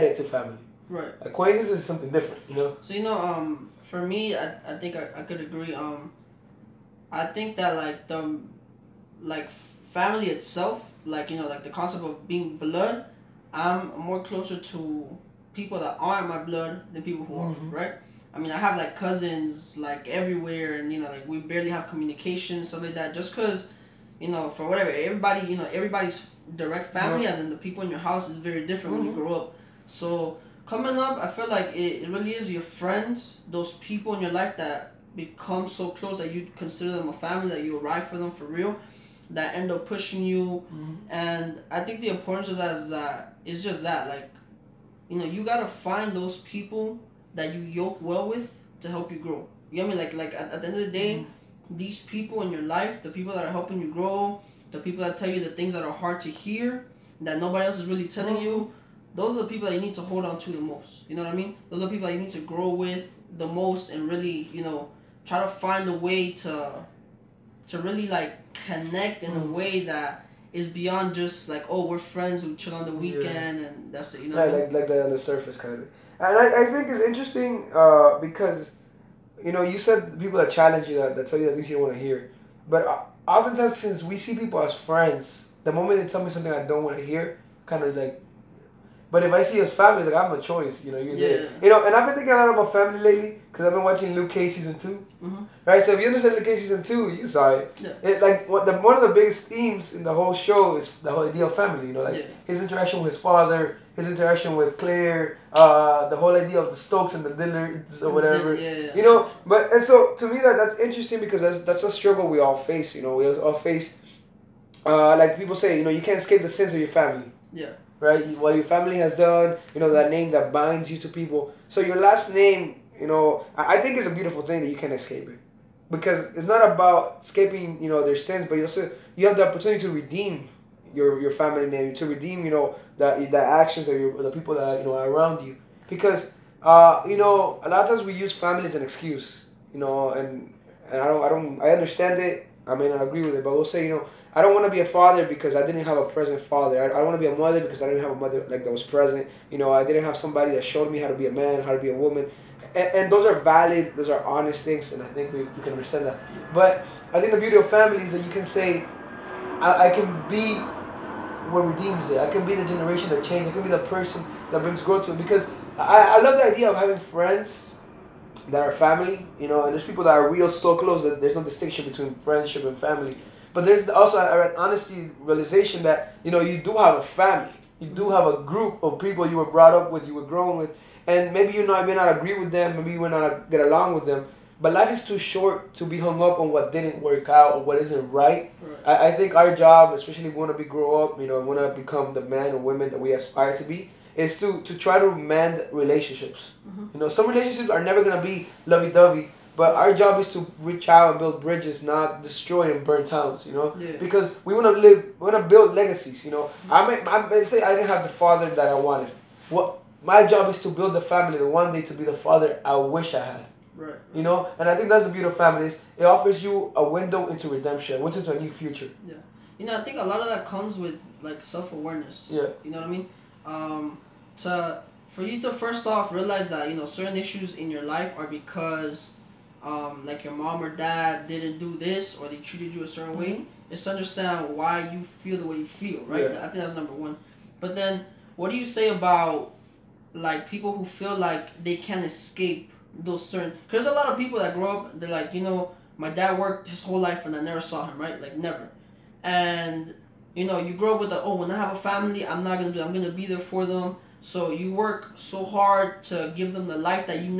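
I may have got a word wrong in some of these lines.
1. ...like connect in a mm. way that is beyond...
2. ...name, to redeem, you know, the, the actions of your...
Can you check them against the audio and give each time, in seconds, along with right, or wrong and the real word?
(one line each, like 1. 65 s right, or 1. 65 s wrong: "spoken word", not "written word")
1. 68 s right
2. 131 s right.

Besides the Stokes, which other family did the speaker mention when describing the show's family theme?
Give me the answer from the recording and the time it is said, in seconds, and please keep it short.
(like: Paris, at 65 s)
The Dillards, at 107 s.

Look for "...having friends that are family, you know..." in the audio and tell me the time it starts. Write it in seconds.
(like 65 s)
166 s.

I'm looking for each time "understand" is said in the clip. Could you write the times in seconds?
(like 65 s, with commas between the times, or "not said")
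96 s, 141 s, 155 s, 233 s.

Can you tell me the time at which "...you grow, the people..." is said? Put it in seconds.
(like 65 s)
53 s.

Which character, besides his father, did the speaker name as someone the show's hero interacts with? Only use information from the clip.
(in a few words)
Claire.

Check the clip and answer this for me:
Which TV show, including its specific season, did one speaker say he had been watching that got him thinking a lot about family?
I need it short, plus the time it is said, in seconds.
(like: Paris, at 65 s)
Luke Cage season 2, at 94 s.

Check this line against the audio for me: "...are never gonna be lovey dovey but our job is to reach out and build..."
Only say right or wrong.
right.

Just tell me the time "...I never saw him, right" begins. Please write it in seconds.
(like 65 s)
247 s.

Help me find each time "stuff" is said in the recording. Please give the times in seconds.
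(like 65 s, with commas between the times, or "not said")
22 s.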